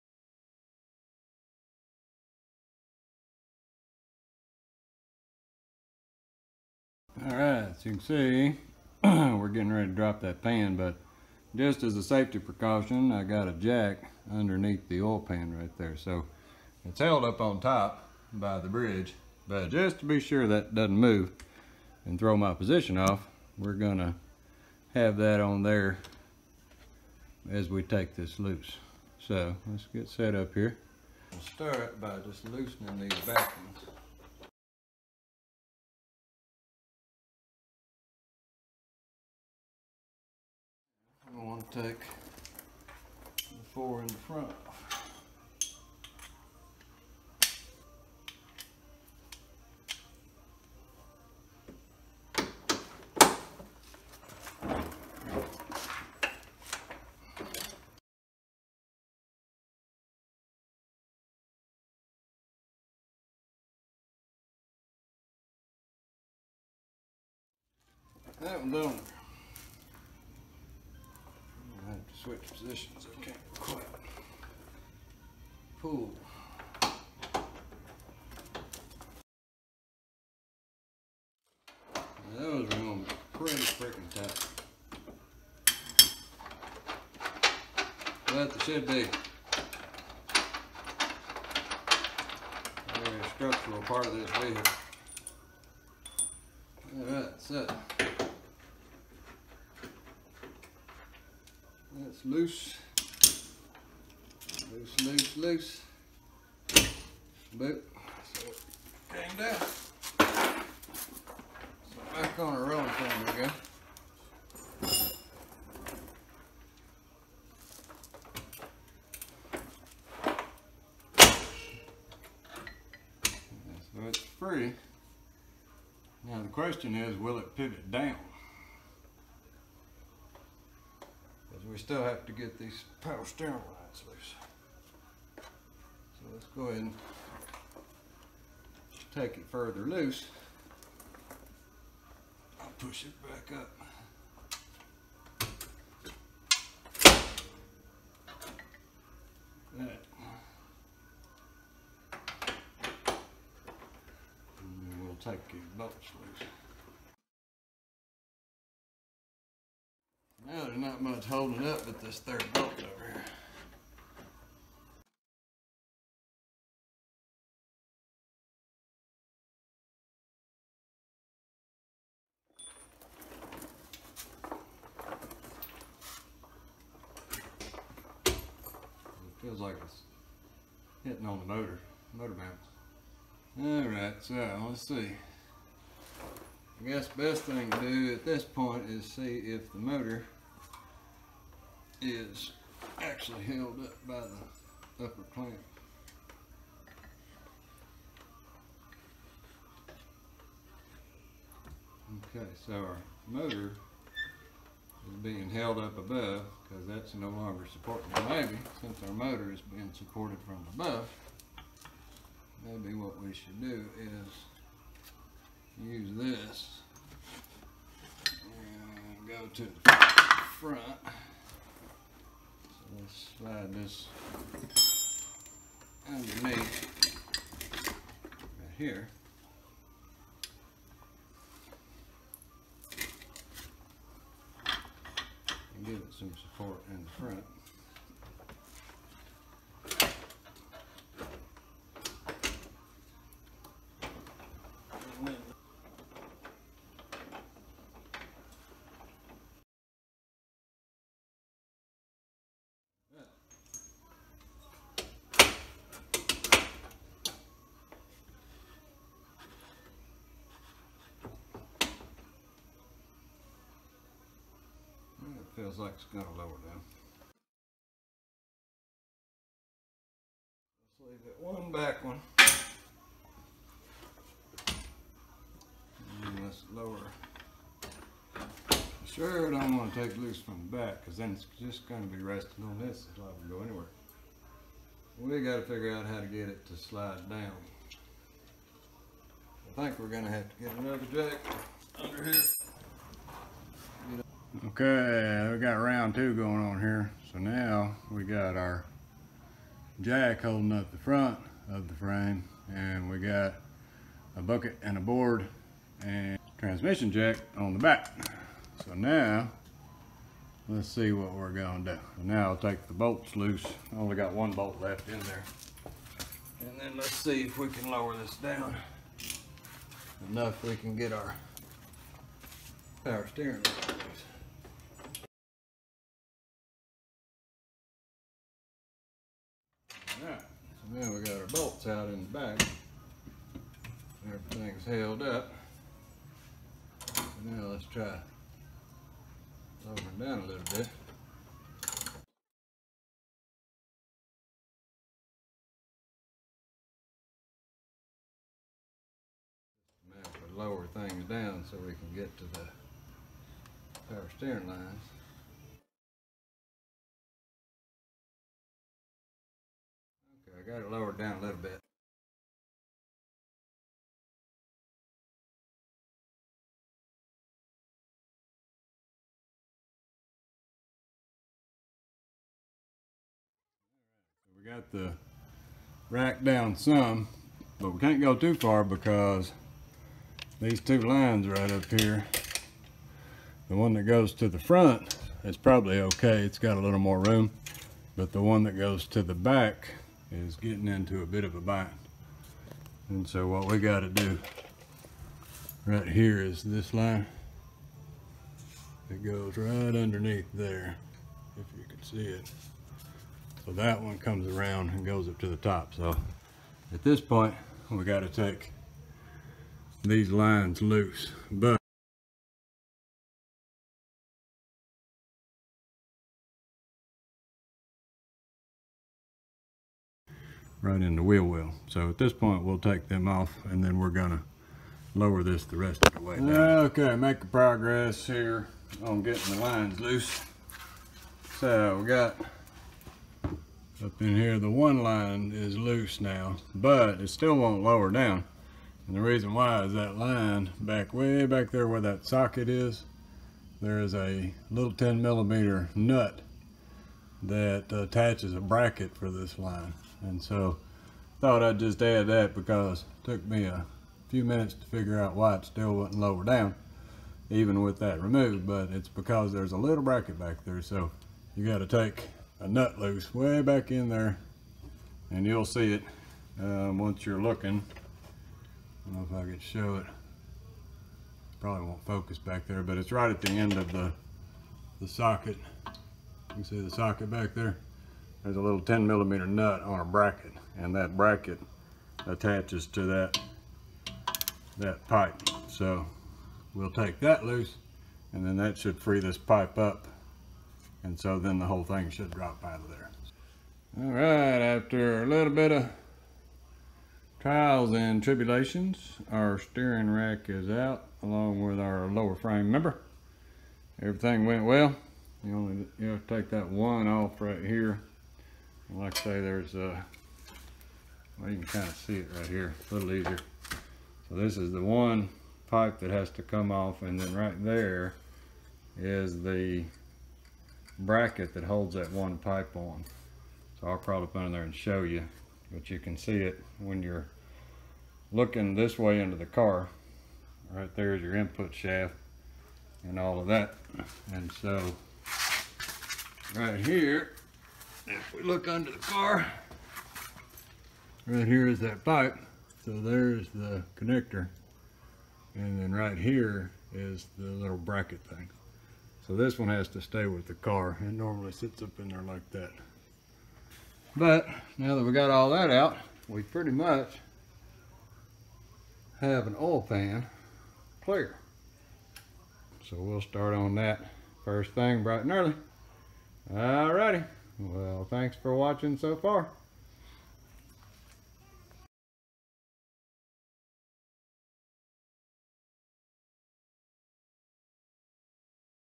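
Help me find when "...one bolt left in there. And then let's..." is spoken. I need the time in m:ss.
5:14.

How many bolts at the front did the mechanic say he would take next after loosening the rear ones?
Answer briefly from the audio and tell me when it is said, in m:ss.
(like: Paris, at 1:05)
4, at 0:43.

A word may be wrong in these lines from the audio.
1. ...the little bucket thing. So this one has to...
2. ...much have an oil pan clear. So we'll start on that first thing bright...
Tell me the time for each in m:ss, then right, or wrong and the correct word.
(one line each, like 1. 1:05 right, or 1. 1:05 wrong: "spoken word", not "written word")
1. 9:07 wrong: "bracket", not "bucket"
2. 9:16 right.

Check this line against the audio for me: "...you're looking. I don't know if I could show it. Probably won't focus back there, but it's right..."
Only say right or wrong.
right.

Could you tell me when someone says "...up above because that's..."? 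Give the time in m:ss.
3:25.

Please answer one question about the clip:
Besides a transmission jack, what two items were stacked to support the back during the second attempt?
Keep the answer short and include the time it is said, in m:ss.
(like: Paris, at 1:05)
a bucket and a board, at 5:04.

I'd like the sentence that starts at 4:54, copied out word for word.
Okay, we got round two going on here.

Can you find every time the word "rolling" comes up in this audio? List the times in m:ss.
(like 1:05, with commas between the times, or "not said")
1:52.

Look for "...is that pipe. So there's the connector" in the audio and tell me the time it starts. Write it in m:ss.
9:01.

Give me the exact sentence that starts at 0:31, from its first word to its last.
We'll start by just loosening these back ones.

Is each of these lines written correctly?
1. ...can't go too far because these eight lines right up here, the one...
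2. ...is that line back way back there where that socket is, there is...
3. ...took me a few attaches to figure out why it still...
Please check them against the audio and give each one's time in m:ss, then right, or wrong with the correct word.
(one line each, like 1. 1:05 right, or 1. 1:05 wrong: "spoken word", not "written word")
1. 6:17 wrong: "two", not "eight"
2. 7:19 right
3. 7:33 wrong: "minutes", not "attaches".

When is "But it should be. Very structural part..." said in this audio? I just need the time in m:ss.
1:28.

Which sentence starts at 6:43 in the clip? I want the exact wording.
So that one comes around and goes up to the top.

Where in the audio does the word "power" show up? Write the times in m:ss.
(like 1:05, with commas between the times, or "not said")
2:12, 5:23, 5:54.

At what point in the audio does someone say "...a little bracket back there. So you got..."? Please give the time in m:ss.
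7:39.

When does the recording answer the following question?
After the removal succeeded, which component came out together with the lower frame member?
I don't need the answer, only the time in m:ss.
8:19.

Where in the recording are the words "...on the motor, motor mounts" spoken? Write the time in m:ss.
3:01.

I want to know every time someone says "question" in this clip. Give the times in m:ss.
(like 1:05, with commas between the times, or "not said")
2:06.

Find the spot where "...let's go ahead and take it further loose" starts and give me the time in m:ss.
2:16.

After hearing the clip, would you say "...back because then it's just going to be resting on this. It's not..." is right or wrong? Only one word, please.
right.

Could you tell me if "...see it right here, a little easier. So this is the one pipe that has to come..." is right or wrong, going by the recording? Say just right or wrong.
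right.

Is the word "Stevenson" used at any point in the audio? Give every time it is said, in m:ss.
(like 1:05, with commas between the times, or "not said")
not said.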